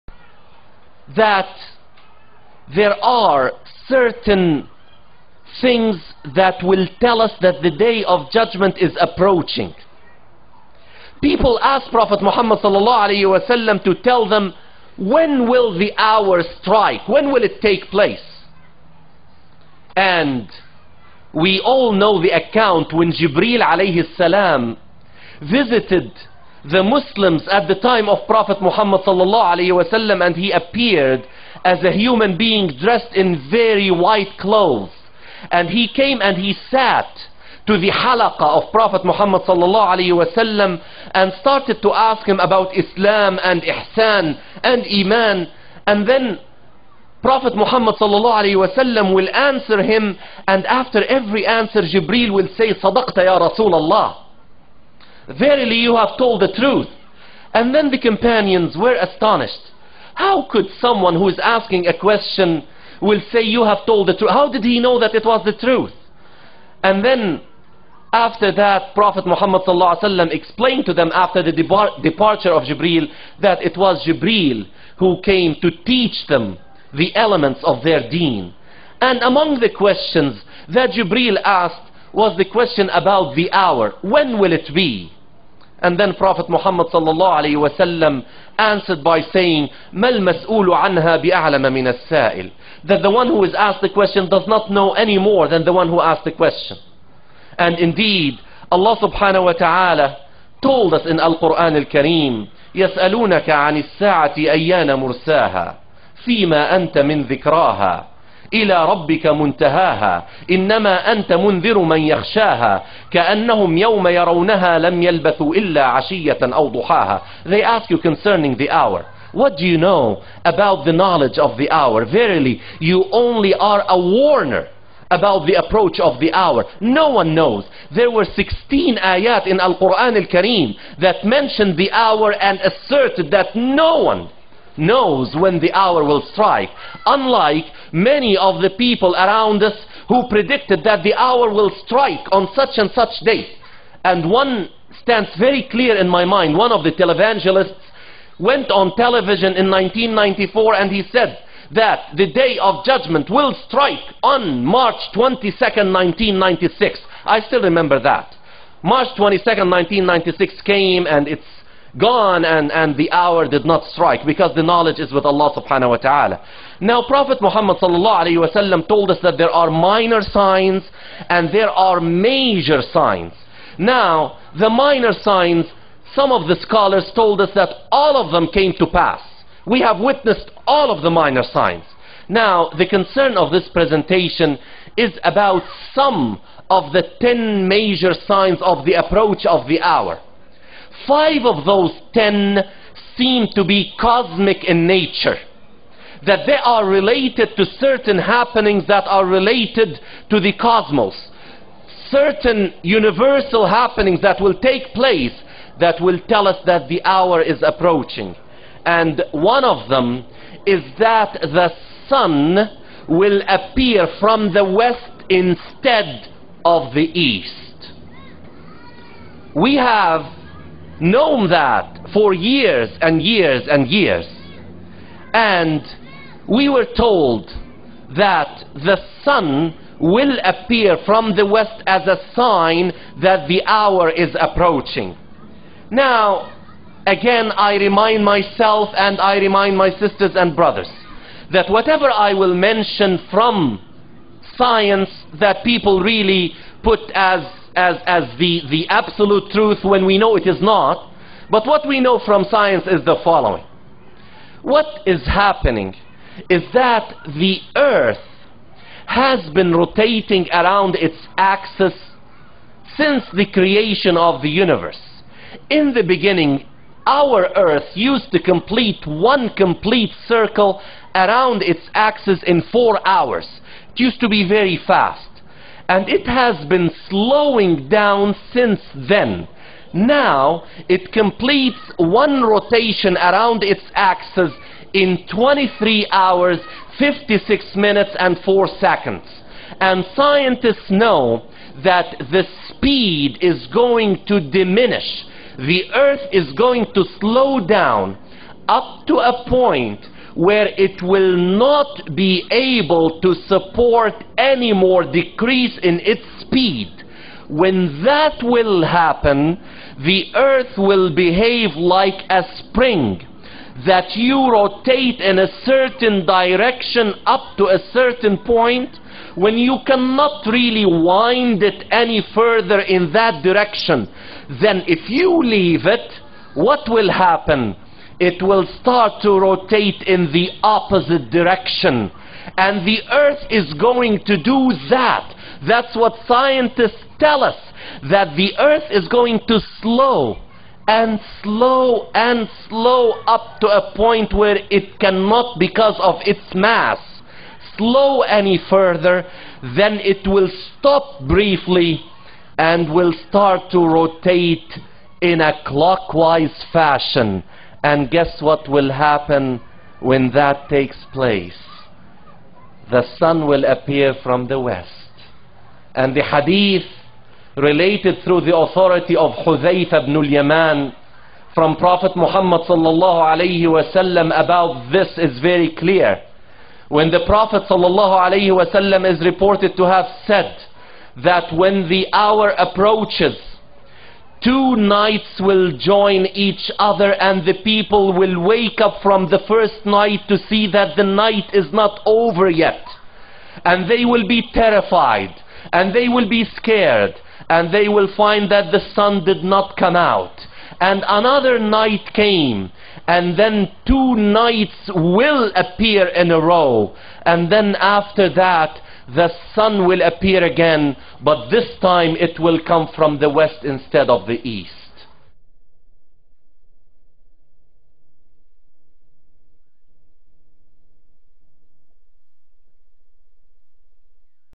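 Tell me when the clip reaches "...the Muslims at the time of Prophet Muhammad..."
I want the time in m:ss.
0:26.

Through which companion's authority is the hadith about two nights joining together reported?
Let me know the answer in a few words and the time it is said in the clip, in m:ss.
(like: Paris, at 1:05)
Hudayfa ibn al-Yaman, at 6:09.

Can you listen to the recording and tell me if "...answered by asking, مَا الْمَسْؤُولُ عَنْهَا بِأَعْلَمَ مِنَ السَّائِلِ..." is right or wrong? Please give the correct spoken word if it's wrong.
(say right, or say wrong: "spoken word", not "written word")
wrong: "saying", not "asking".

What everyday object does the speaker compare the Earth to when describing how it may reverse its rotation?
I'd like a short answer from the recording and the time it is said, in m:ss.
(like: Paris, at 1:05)
A spring, at 5:12.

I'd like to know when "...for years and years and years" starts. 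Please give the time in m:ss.
3:42.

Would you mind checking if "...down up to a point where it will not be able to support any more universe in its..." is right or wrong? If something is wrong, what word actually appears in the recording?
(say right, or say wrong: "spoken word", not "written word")
wrong: "decrease", not "universe".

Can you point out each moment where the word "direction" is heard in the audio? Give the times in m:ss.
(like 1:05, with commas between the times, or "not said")
5:16, 5:23, 5:31.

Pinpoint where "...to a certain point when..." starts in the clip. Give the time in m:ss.
5:17.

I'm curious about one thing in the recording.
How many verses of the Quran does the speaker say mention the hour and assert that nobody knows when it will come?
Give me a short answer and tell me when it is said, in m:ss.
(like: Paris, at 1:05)
16, at 2:08.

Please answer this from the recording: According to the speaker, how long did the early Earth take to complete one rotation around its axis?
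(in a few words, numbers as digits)
4 hours.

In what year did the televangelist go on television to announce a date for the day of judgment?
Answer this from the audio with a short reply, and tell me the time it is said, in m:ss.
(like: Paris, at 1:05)
1994, at 2:29.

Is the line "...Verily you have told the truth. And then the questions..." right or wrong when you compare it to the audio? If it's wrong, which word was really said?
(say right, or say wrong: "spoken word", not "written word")
wrong: "companions", not "questions".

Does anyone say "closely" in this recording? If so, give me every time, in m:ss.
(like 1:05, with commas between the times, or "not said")
not said.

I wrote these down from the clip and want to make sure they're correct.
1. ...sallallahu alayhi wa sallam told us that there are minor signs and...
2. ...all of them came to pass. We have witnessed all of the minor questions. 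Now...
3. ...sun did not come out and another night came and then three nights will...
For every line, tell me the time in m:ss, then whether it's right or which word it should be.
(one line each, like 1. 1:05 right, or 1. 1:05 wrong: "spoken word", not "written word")
1. 2:47 right
2. 2:57 wrong: "signs", not "questions"
3. 6:38 wrong: "two", not "three".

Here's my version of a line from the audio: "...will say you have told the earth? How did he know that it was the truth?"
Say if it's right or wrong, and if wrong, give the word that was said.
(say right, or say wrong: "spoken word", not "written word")
wrong: "truth", not "earth".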